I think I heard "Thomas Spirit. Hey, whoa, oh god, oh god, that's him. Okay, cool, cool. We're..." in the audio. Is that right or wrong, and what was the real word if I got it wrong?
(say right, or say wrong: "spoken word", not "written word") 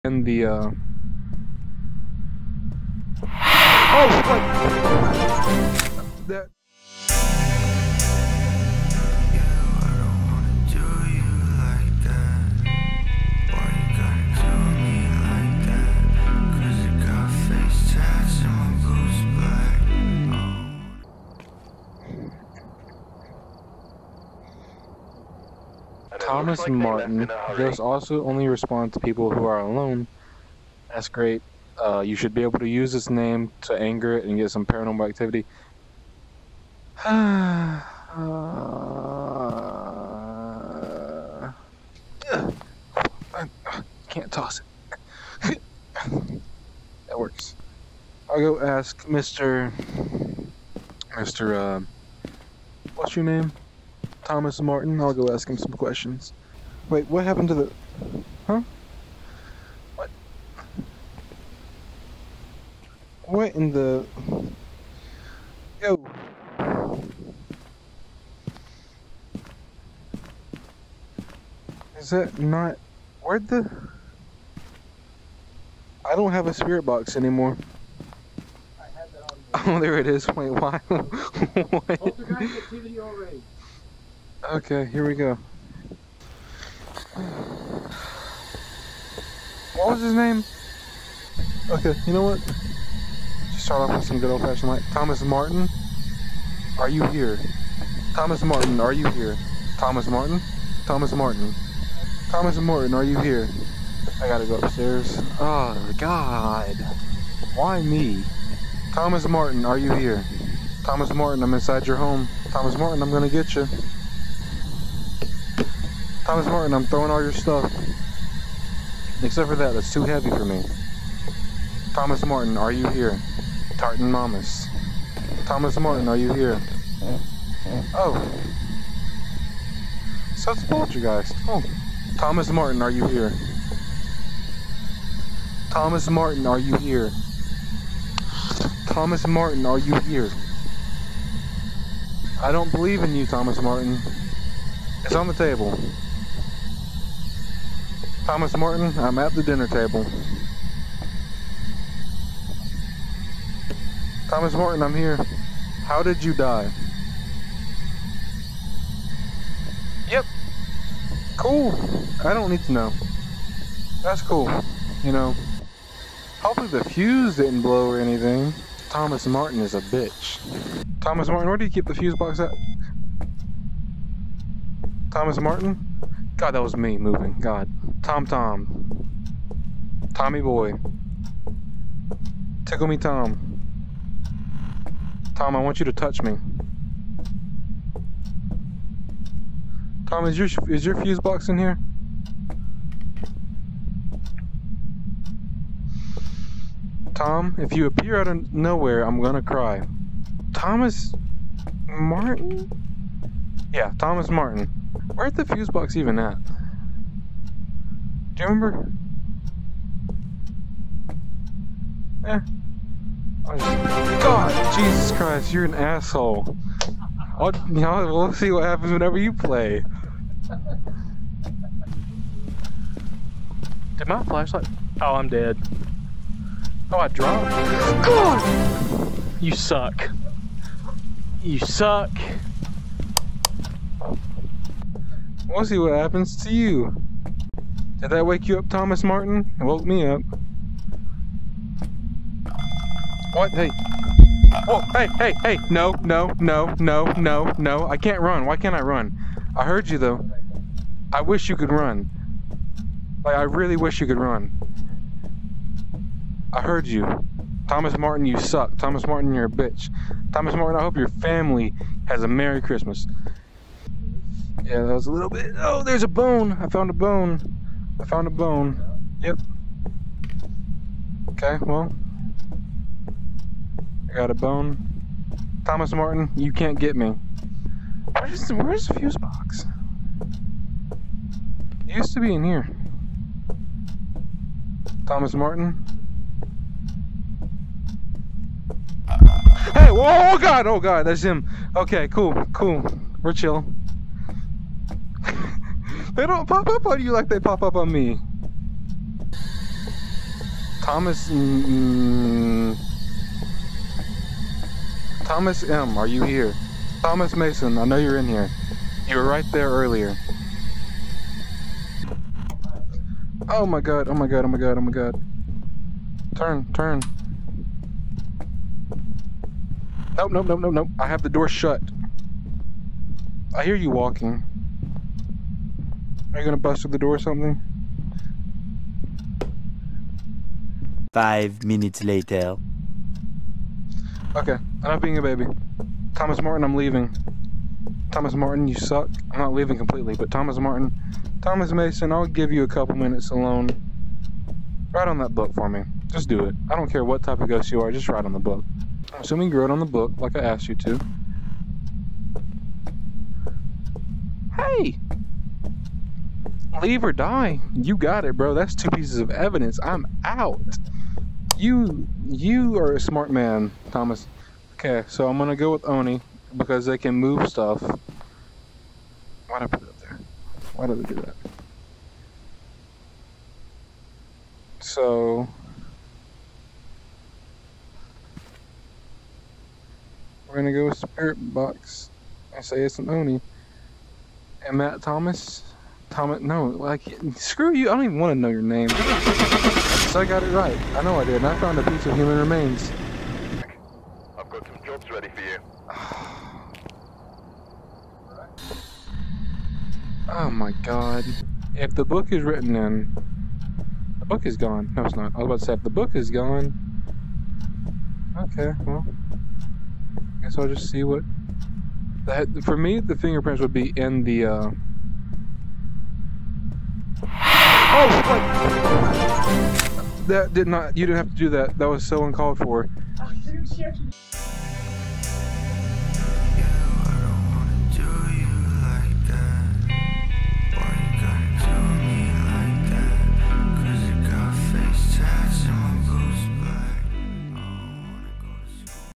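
wrong: "Martin", not "Spirit".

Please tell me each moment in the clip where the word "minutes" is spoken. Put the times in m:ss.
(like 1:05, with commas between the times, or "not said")
5:31, 5:42.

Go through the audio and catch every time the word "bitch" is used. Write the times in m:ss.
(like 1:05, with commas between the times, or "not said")
2:49, 4:19.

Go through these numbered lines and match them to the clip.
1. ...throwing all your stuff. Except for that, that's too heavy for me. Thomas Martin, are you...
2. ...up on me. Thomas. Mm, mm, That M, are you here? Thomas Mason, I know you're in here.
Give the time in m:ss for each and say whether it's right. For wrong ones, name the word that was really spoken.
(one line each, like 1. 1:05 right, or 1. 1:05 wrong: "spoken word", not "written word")
1. 1:56 right
2. 4:57 wrong: "Thomas", not "That".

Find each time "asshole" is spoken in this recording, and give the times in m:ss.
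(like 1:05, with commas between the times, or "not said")
3:35.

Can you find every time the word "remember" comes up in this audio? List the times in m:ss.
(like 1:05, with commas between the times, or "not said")
3:28.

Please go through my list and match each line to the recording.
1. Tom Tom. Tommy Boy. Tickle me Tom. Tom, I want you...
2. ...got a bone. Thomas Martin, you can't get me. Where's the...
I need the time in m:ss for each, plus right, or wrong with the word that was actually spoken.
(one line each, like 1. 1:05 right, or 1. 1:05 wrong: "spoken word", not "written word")
1. 2:58 right
2. 4:34 right.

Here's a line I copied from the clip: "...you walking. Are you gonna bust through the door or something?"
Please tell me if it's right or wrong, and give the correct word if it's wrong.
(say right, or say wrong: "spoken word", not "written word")
right.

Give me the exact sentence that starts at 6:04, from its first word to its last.
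Okay, so I'm gonna go with Oni because they can move stuff.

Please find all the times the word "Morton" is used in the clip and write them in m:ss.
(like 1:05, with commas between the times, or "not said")
2:28, 2:34.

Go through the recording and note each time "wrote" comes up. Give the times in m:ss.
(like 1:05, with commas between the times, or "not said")
5:49.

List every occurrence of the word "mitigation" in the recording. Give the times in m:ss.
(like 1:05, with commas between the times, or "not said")
not said.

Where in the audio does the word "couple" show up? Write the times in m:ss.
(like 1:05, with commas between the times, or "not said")
5:42.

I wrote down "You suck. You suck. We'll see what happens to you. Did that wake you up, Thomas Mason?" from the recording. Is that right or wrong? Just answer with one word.
wrong.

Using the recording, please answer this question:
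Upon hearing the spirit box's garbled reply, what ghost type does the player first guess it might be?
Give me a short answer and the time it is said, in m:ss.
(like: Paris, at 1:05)
Poltergeist, at 2:10.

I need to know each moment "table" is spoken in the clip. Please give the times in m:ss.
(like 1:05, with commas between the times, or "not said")
2:25, 2:29.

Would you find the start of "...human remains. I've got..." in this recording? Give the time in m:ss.
6:32.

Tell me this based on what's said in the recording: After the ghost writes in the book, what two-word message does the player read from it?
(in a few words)
leave or die.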